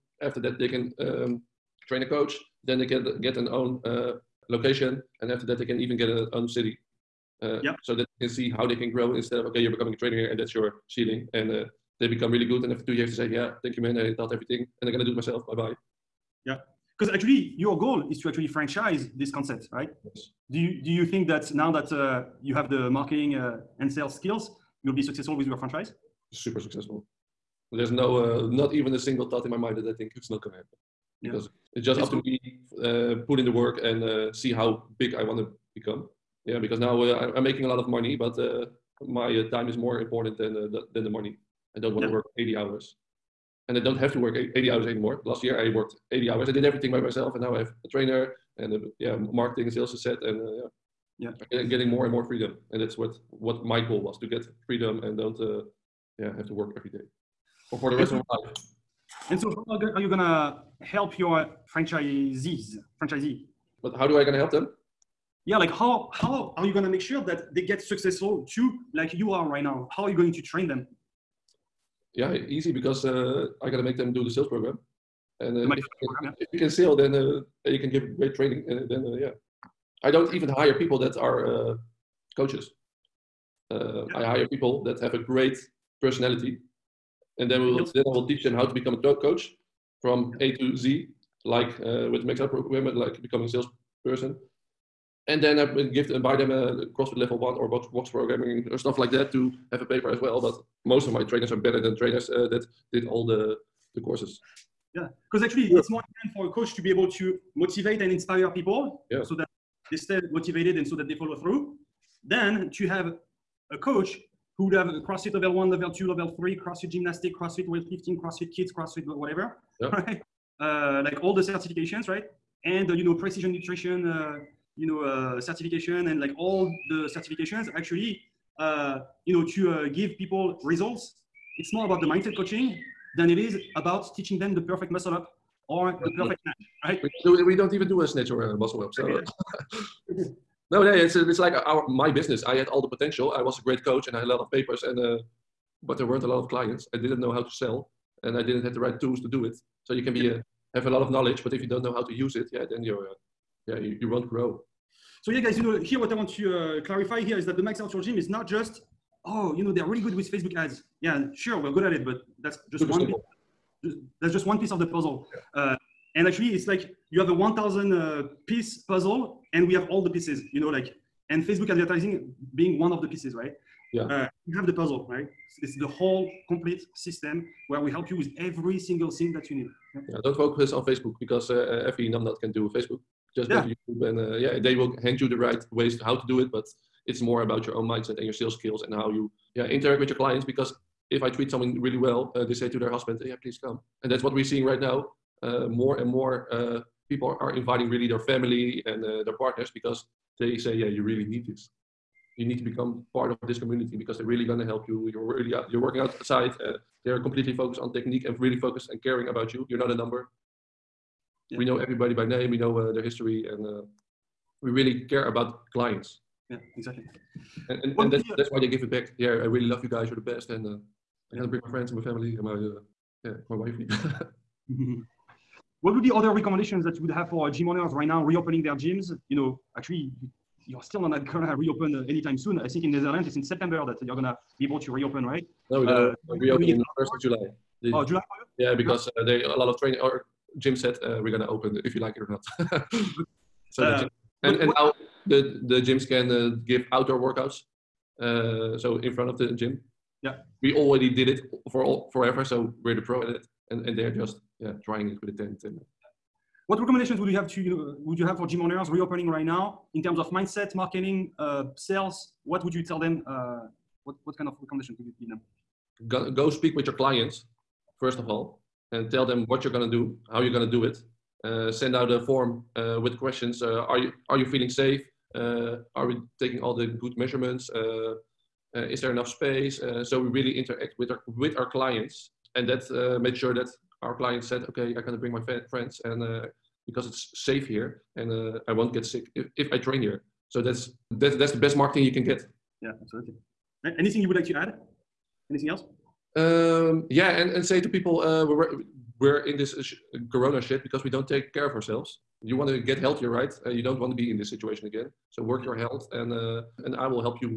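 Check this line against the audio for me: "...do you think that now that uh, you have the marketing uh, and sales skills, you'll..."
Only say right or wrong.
right.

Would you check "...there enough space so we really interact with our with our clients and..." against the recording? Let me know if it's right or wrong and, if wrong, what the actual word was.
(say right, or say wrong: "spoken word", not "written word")
right.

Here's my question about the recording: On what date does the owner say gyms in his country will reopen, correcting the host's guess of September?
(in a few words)
1 July.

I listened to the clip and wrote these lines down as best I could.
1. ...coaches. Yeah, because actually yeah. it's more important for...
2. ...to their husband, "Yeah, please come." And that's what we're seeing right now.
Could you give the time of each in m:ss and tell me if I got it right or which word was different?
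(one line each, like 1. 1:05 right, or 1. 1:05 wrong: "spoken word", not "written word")
1. 1:43 wrong: "courses", not "coaches"
2. 3:12 right.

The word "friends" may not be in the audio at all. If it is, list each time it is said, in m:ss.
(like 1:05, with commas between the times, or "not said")
3:41, 4:45.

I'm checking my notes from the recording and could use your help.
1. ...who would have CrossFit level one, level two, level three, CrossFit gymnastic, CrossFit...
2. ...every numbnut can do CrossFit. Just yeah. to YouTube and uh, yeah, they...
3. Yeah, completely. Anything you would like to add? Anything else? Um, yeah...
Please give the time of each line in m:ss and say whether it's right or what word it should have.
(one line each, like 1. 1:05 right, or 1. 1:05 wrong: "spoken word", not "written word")
1. 1:54 right
2. 3:01 wrong: "Facebook", not "CrossFit"
3. 4:52 wrong: "absolutely", not "completely".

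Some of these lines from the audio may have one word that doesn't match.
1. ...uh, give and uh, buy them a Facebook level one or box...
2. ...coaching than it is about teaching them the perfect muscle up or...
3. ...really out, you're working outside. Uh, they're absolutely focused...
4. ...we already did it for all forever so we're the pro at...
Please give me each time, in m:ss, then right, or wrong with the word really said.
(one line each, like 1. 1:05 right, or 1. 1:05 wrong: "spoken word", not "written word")
1. 1:35 wrong: "CrossFit", not "Facebook"
2. 2:12 right
3. 3:25 wrong: "completely", not "absolutely"
4. 4:10 right.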